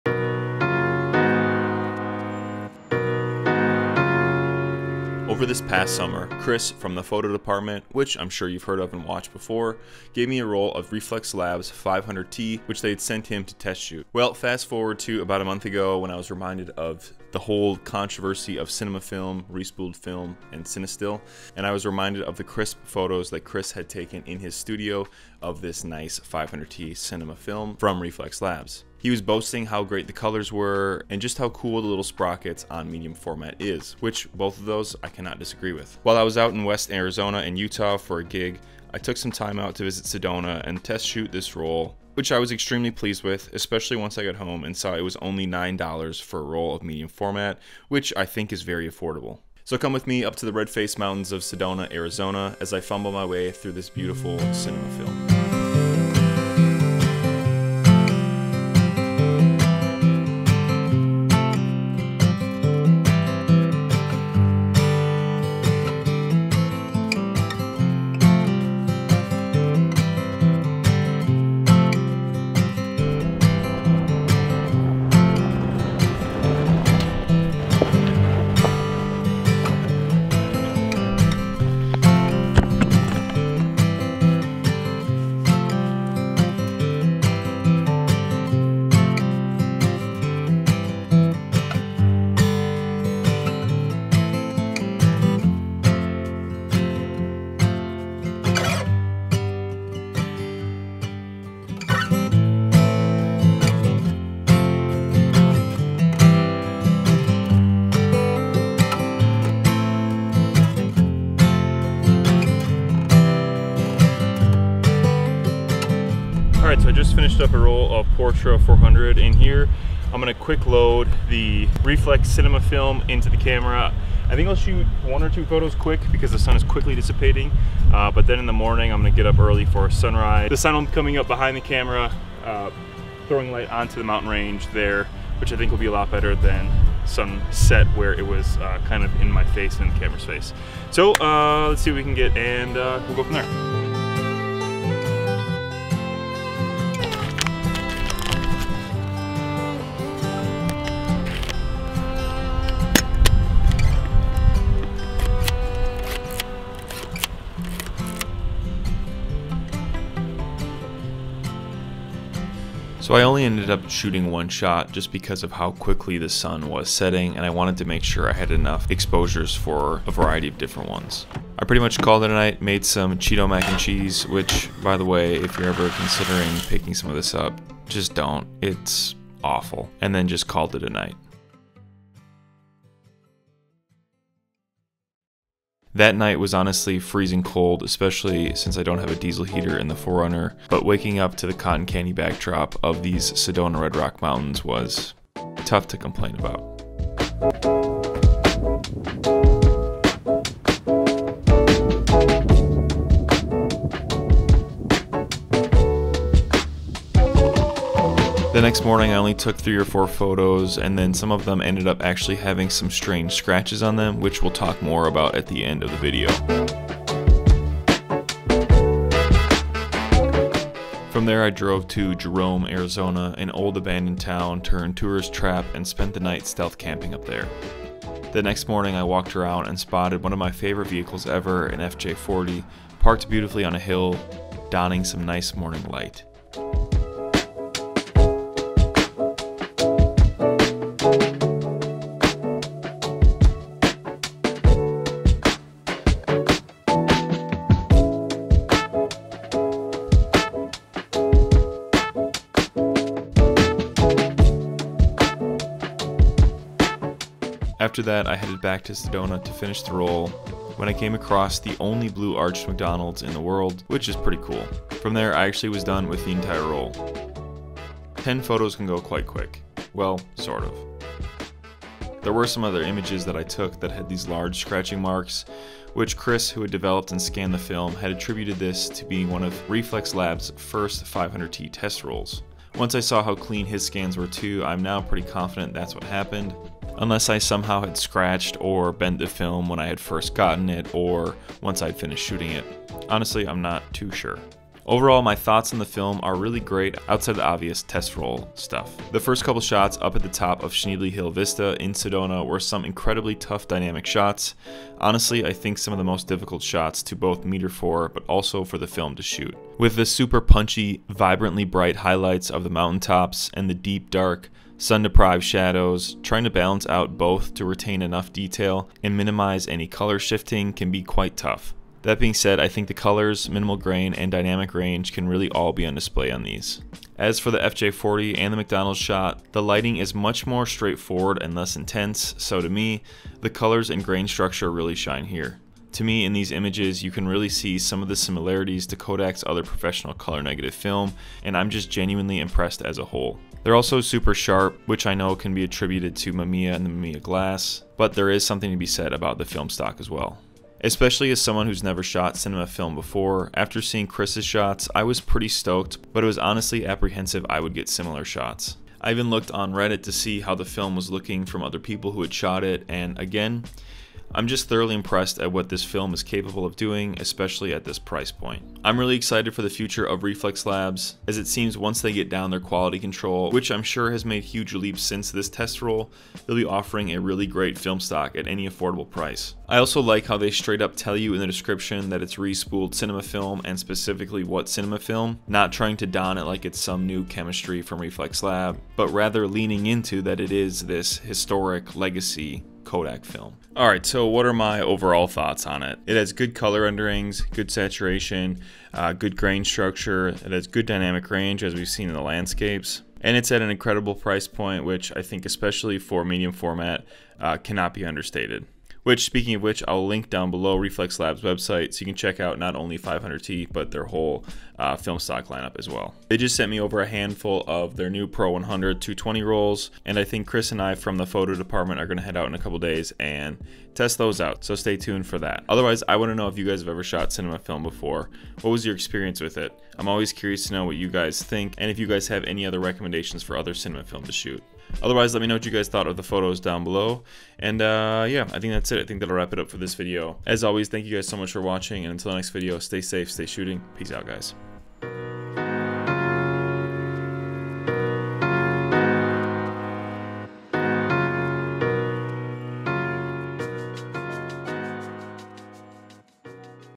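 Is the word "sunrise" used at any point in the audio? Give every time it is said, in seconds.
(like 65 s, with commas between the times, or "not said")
129 s.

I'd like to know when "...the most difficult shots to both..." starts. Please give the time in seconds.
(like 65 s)
305 s.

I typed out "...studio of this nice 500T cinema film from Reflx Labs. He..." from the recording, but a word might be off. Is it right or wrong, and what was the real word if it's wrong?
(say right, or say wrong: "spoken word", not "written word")
right.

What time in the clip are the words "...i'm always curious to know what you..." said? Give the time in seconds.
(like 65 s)
429 s.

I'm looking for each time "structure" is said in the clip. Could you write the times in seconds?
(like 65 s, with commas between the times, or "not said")
334 s, 399 s.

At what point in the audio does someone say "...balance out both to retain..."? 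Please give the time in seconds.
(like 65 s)
316 s.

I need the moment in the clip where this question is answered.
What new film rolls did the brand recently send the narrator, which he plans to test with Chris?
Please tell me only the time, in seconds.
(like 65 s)
418 s.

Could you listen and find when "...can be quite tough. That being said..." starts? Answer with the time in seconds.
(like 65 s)
320 s.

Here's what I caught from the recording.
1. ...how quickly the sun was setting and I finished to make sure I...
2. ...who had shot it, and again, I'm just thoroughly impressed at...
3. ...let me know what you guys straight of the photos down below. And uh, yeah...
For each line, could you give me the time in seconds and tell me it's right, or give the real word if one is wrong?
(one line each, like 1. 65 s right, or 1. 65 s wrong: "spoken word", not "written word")
1. 165 s wrong: "wanted", not "finished"
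2. 362 s right
3. 435 s wrong: "thought", not "straight".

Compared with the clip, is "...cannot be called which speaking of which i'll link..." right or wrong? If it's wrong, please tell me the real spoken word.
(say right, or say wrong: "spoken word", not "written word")
wrong: "understated", not "called".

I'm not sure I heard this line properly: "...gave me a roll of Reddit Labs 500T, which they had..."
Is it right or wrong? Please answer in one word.
wrong.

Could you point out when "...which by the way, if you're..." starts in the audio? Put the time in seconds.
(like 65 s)
174 s.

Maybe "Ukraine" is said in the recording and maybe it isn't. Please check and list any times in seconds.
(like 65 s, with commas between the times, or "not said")
not said.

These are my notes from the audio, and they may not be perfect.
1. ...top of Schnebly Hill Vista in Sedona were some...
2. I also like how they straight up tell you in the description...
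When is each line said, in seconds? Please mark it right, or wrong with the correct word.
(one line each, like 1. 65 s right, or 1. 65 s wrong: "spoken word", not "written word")
1. 300 s right
2. 379 s right.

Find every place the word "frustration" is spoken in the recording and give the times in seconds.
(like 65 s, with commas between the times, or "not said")
not said.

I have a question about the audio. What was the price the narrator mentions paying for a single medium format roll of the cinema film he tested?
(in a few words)
$9.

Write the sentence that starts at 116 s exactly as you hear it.
right, so I just finished up a roll of Portra 400 in here.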